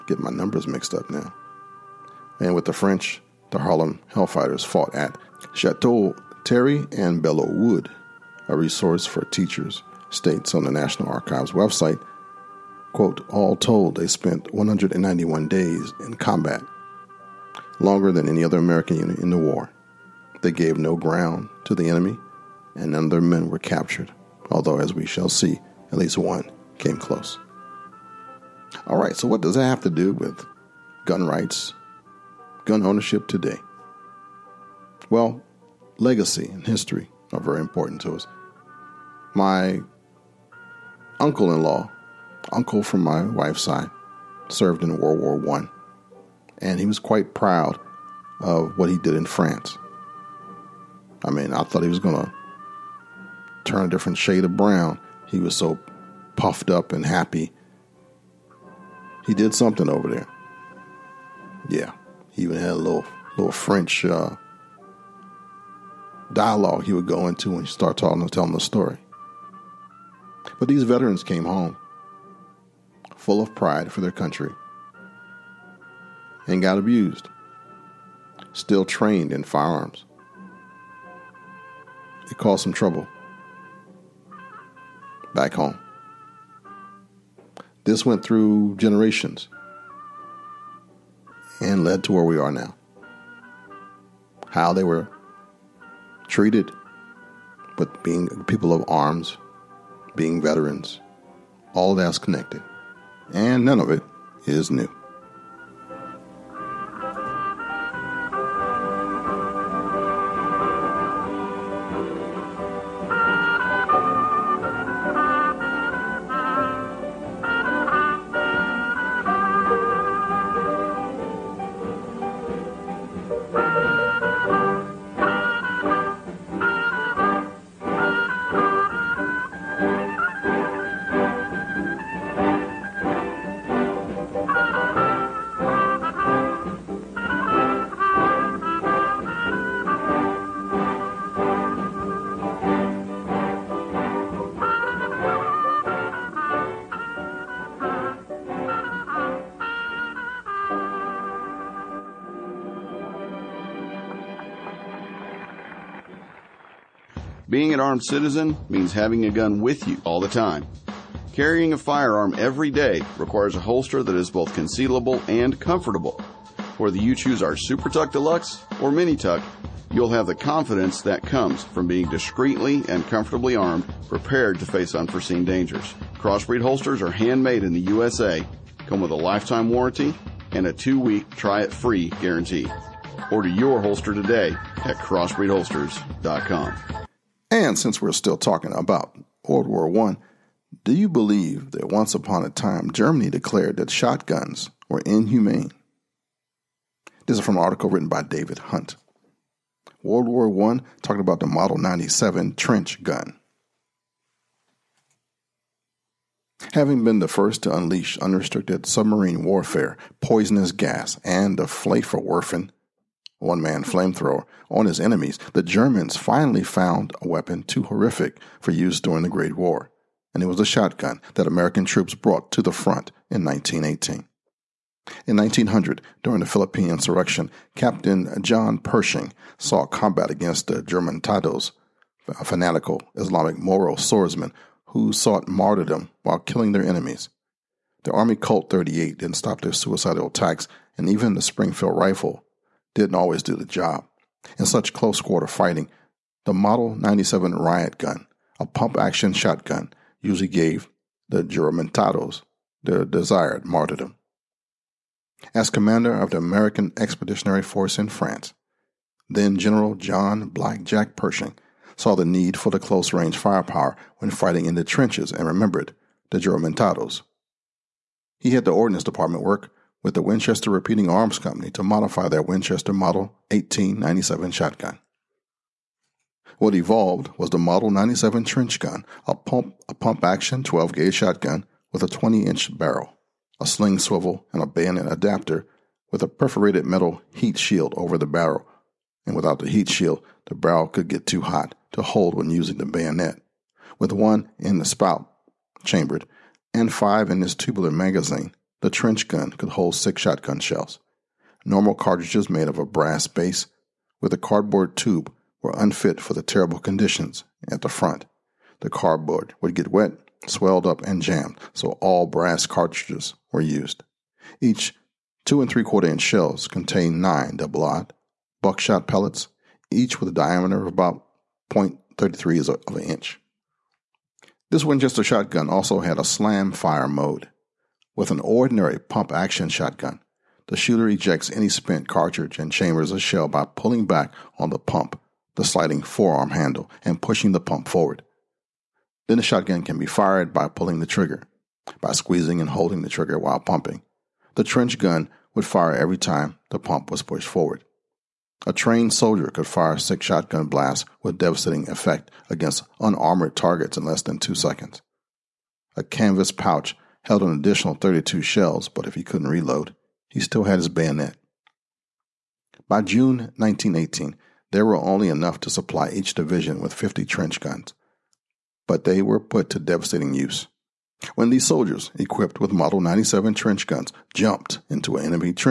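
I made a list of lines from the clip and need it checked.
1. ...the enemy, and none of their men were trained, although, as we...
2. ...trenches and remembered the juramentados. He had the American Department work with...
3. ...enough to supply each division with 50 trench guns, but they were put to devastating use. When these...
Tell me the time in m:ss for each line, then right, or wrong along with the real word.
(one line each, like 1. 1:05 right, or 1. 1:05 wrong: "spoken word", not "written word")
1. 0:21 wrong: "captured", not "trained"
2. 4:24 wrong: "Ordnance", not "American"
3. 6:05 right.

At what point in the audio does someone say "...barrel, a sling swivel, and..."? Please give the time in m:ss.
4:42.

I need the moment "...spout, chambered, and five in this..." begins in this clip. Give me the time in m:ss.
4:54.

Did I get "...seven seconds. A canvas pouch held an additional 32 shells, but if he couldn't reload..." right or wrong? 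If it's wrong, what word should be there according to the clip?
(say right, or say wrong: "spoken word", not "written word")
wrong: "two", not "seven".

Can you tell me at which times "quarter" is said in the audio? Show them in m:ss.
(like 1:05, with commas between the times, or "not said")
4:05, 5:15.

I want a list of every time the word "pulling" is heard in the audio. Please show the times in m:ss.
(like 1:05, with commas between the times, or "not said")
5:33, 5:40.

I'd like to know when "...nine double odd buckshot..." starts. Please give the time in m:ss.
5:17.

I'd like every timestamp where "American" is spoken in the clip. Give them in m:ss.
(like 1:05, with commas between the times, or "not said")
0:18, 3:41, 4:16.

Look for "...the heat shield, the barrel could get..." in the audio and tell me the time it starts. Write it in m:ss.
4:49.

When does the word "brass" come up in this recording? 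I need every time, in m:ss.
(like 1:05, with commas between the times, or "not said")
5:02, 5:12.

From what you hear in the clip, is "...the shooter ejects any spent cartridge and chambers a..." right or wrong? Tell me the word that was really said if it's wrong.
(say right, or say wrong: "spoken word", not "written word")
right.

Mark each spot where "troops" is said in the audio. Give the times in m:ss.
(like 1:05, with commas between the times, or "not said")
3:41.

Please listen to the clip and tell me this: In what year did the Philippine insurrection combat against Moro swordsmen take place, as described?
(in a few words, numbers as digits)
1900.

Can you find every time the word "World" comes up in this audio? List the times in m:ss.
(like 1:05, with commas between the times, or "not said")
0:44, 3:09, 3:20.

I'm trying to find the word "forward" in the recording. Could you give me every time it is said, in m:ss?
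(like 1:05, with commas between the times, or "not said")
5:37, 5:47.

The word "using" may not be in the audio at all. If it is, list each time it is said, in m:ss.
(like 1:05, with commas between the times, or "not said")
4:52.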